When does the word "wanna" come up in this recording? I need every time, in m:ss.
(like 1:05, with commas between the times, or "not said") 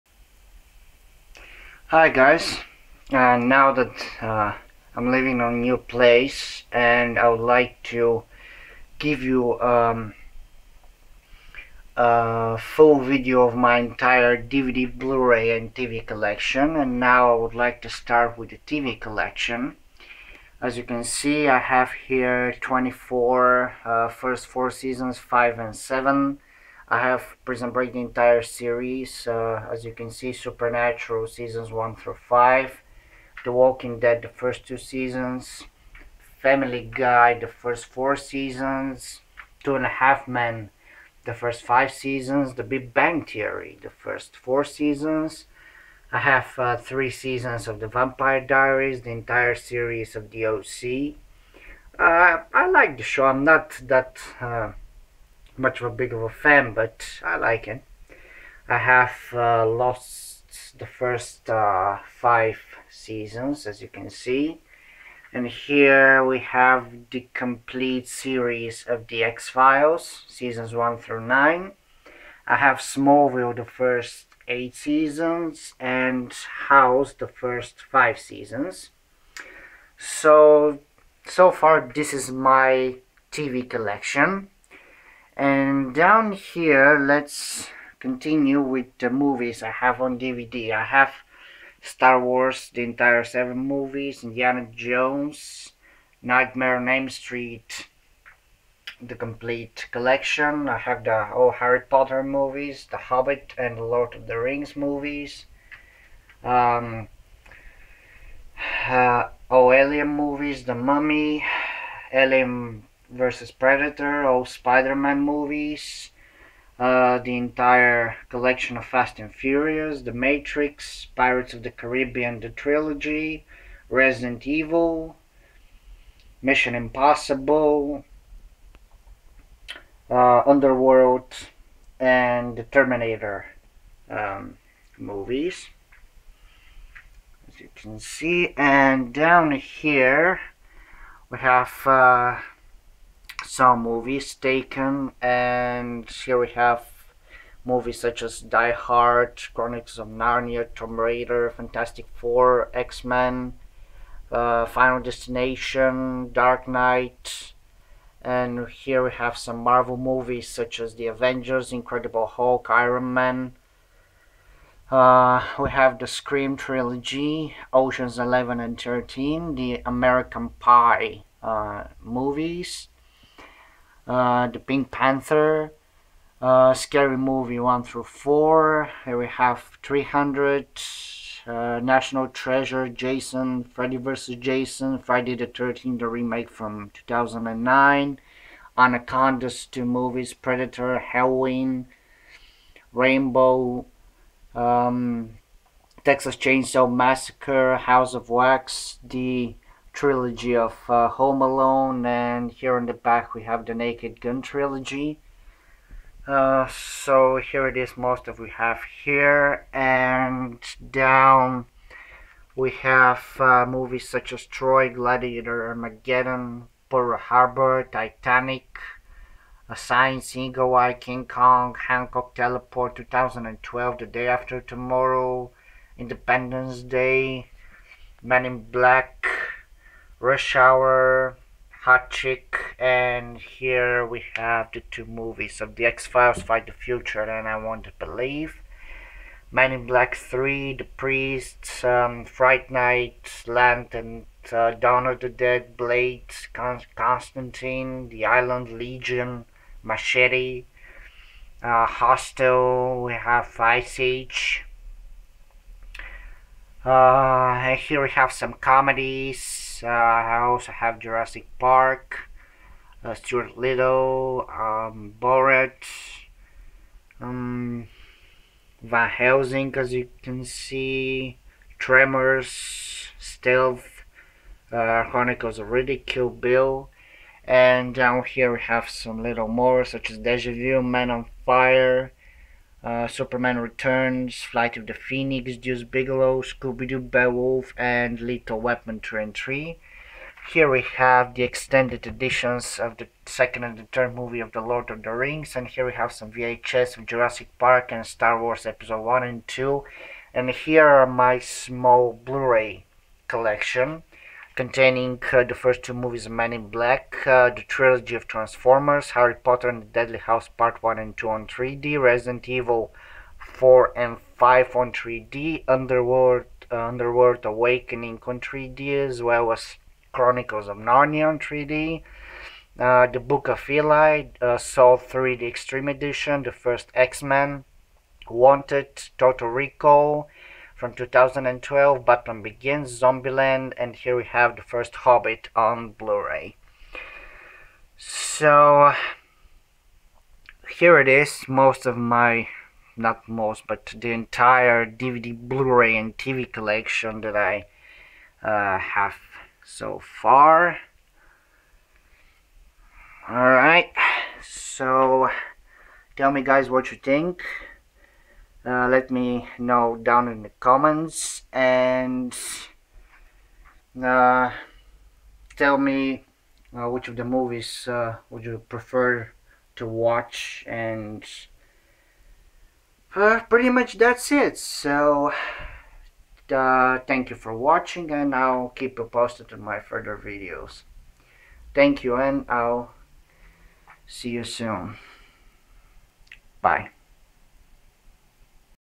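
not said.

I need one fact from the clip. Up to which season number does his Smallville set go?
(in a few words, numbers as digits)
8.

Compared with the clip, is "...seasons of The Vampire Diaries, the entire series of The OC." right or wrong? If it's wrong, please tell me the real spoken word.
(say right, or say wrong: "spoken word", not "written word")
right.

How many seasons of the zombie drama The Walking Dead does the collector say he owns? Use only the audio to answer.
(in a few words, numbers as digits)
2.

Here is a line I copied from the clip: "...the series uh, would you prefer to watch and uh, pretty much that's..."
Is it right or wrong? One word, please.
wrong.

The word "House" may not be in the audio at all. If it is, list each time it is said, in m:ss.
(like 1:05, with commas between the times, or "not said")
1:16, 3:17.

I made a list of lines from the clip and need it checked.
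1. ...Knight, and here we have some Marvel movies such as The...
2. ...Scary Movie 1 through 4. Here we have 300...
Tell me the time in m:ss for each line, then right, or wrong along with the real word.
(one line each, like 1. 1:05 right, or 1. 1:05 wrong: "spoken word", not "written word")
1. 2:36 right
2. 2:56 right.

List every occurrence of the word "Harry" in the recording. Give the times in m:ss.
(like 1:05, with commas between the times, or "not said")
1:41, 5:09.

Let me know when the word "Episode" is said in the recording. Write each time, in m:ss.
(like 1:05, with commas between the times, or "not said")
4:58.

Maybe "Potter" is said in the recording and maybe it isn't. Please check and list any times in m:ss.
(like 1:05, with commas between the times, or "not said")
1:41, 5:09.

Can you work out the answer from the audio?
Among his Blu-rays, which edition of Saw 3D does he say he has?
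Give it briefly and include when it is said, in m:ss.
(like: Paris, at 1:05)
Extreme Edition, at 5:25.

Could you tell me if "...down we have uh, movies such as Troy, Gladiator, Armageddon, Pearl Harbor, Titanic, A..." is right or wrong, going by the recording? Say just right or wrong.
right.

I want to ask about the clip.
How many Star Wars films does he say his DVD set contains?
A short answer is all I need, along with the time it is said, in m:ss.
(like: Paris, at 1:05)
7, at 1:32.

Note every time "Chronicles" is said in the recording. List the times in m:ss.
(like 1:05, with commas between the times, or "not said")
2:29, 4:35, 5:20.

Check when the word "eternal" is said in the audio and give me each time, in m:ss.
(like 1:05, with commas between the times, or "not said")
not said.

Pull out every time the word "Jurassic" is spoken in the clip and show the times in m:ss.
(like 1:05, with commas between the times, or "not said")
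4:20, 4:57.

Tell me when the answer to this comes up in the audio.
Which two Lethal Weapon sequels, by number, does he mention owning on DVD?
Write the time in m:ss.
4:48.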